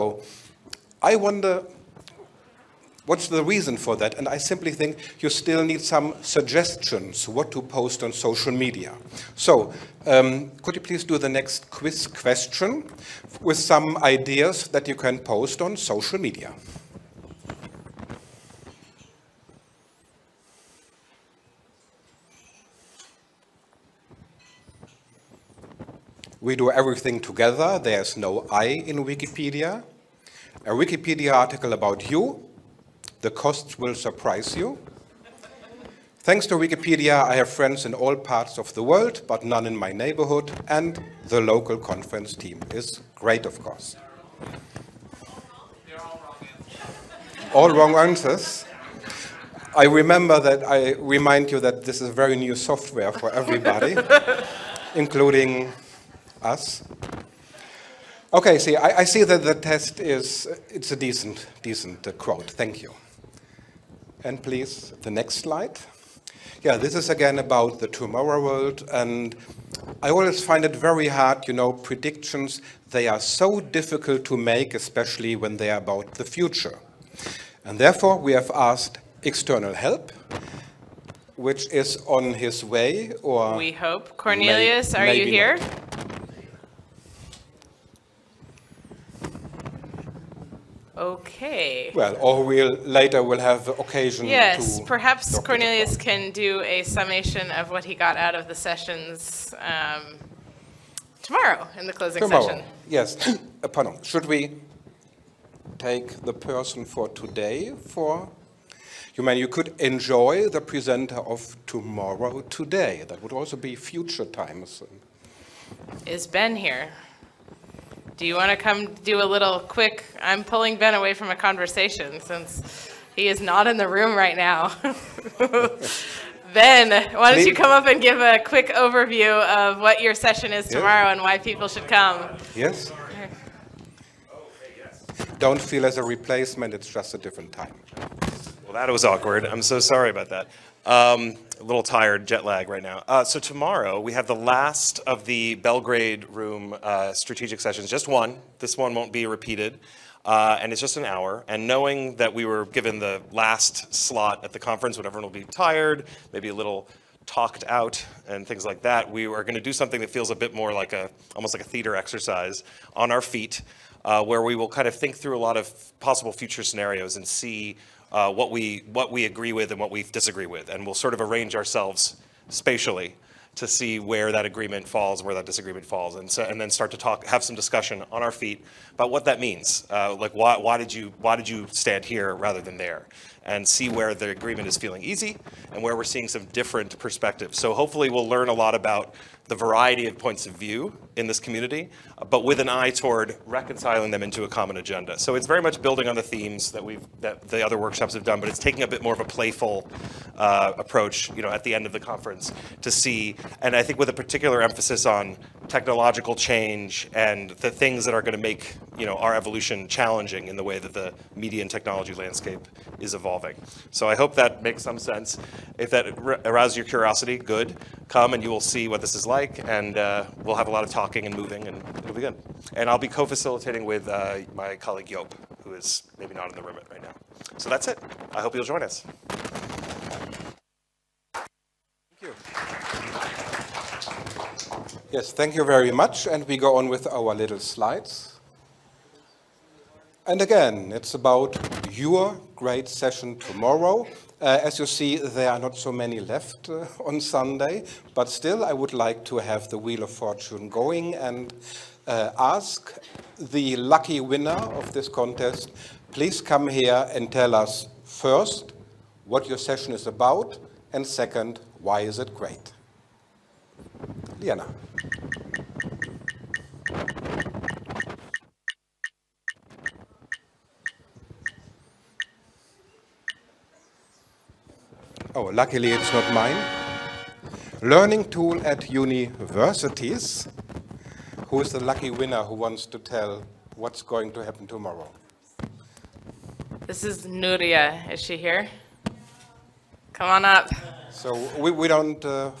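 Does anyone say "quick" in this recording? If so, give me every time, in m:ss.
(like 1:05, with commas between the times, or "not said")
1:59, 2:08.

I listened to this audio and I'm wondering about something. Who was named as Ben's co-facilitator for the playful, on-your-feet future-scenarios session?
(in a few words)
Yop.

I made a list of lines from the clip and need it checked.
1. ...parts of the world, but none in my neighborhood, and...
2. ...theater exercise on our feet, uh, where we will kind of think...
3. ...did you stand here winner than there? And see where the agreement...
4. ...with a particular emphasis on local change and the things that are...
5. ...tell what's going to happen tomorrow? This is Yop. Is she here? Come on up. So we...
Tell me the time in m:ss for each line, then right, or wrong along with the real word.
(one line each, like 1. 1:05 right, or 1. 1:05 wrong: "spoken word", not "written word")
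1. 0:38 right
2. 2:41 right
3. 3:01 wrong: "rather", not "winner"
4. 3:23 wrong: "technological", not "local"
5. 4:42 wrong: "Nuria", not "Yop".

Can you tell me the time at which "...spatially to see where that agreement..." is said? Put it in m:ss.
2:52.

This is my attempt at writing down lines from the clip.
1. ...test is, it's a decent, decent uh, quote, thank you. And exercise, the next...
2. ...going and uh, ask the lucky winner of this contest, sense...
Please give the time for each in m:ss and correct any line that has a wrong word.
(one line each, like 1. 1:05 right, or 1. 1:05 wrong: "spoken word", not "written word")
1. 0:59 wrong: "please", not "exercise"
2. 4:10 wrong: "please", not "sense".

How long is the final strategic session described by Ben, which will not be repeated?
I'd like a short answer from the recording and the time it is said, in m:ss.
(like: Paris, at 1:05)
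an hour, at 2:30.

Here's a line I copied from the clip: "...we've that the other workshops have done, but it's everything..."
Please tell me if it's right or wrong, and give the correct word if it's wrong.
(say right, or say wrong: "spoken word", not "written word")
wrong: "taking", not "everything".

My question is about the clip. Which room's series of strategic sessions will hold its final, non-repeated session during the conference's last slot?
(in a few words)
Belgrade Room.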